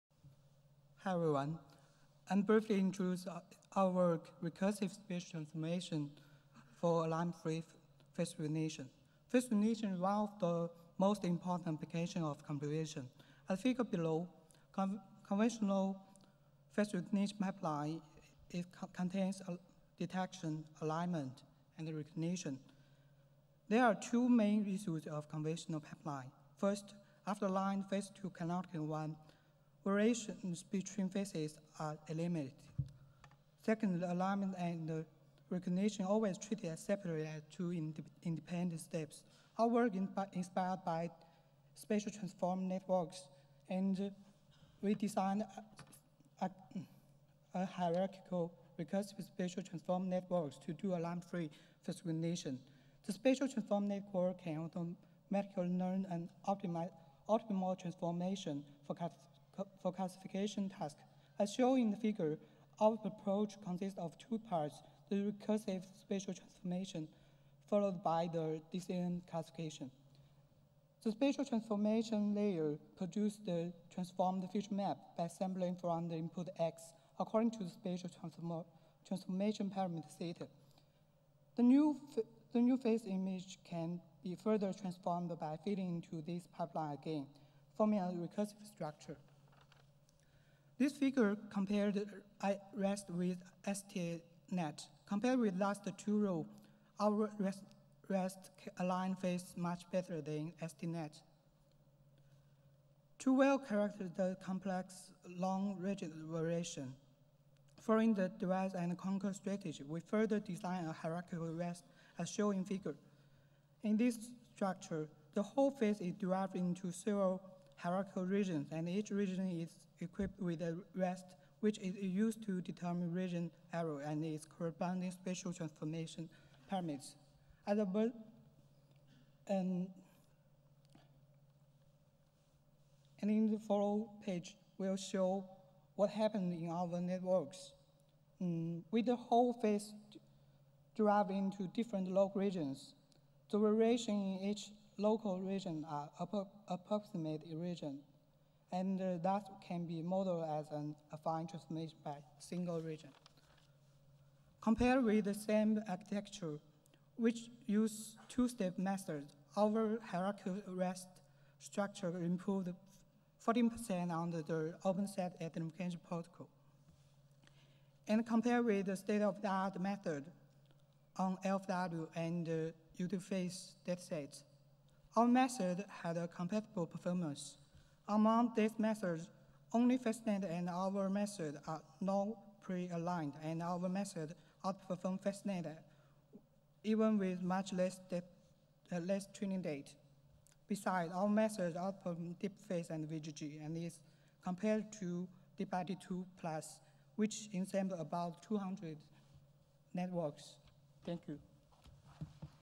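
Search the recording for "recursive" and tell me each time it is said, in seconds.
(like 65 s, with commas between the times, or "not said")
4 s, 48 s, 65 s, 88 s.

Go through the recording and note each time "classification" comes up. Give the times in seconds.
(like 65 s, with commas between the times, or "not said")
59 s, 69 s.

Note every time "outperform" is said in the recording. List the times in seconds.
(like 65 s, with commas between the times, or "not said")
184 s, 191 s.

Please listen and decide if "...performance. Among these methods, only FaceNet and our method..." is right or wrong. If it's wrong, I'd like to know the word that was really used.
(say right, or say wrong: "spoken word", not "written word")
right.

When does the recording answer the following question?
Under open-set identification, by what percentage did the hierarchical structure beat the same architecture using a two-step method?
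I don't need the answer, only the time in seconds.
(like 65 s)
163 s.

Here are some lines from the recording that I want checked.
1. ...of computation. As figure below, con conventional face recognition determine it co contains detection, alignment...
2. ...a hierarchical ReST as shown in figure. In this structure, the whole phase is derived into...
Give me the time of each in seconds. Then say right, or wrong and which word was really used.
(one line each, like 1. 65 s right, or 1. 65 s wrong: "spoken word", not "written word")
1. 12 s wrong: "pipeline", not "determine"
2. 110 s right.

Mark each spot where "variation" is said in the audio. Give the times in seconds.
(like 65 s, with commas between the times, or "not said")
29 s, 106 s, 143 s.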